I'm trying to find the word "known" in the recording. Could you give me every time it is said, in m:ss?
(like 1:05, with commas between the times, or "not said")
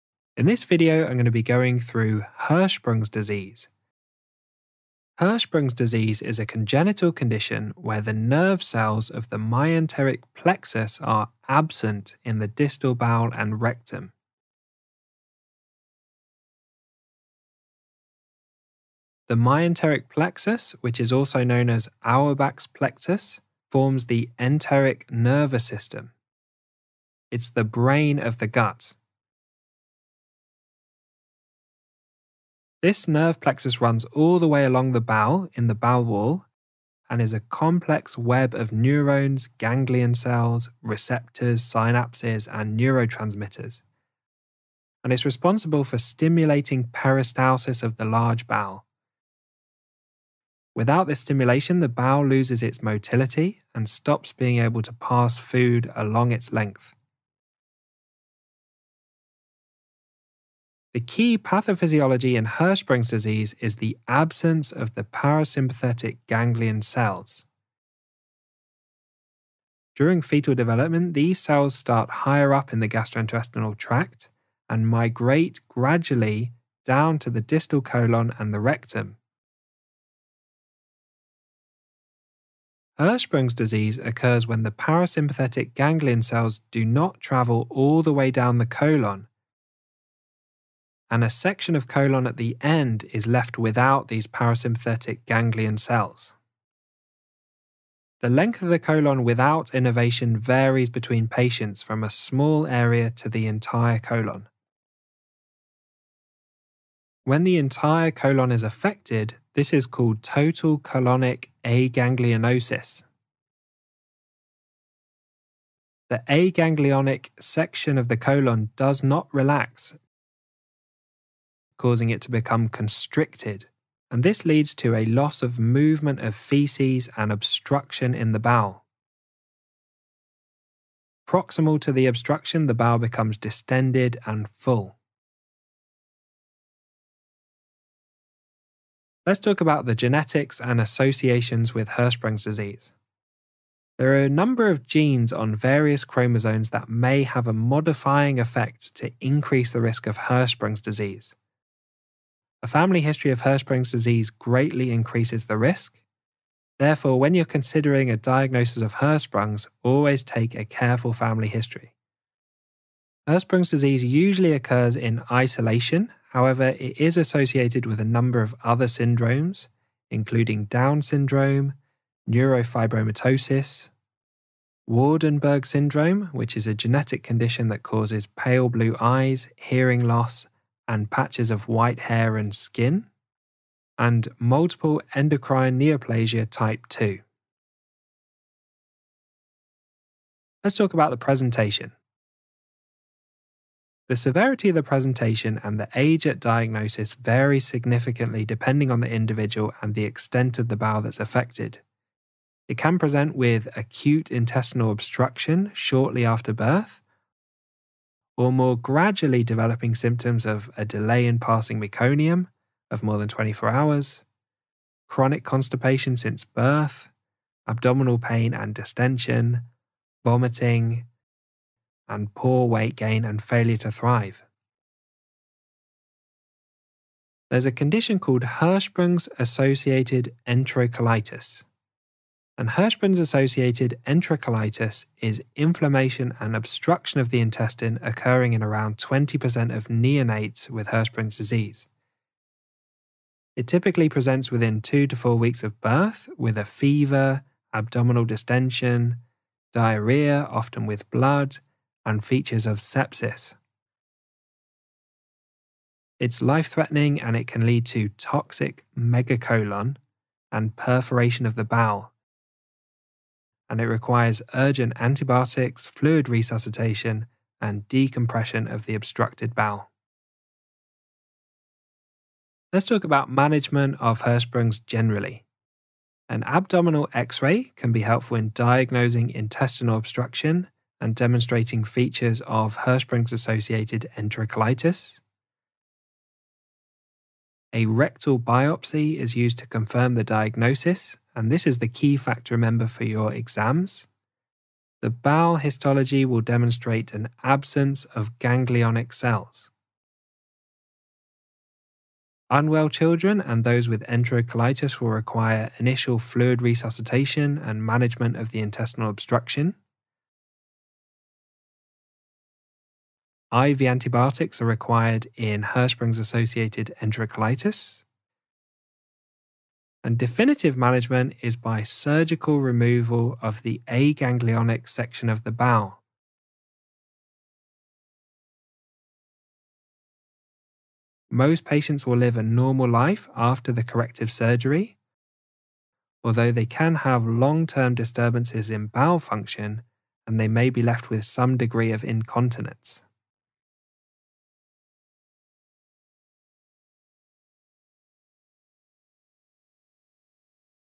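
0:21.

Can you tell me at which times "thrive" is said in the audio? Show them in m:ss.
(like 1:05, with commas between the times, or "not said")
3:43.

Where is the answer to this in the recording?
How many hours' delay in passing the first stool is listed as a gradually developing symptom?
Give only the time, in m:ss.
3:33.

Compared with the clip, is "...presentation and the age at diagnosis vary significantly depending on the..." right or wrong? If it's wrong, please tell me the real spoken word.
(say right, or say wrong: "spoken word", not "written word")
right.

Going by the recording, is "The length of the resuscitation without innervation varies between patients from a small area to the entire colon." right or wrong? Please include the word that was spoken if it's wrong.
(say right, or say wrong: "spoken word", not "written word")
wrong: "colon", not "resuscitation".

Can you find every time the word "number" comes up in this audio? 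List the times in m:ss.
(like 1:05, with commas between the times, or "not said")
2:24, 2:48.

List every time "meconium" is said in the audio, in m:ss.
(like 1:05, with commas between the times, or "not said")
3:31.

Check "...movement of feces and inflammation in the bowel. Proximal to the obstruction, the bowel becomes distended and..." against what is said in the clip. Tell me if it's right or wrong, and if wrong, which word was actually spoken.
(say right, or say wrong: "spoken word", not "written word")
wrong: "obstruction", not "inflammation".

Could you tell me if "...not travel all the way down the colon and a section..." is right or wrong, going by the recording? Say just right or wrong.
right.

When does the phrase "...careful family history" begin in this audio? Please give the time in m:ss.
2:40.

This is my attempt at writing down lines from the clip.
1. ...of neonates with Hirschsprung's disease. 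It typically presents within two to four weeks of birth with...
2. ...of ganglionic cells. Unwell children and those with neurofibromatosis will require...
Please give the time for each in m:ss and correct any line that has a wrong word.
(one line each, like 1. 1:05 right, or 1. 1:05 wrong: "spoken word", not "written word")
1. 3:59 right
2. 4:58 wrong: "enterocolitis", not "neurofibromatosis".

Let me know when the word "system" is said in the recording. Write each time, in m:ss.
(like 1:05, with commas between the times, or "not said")
0:25.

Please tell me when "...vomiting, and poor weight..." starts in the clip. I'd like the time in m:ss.
3:40.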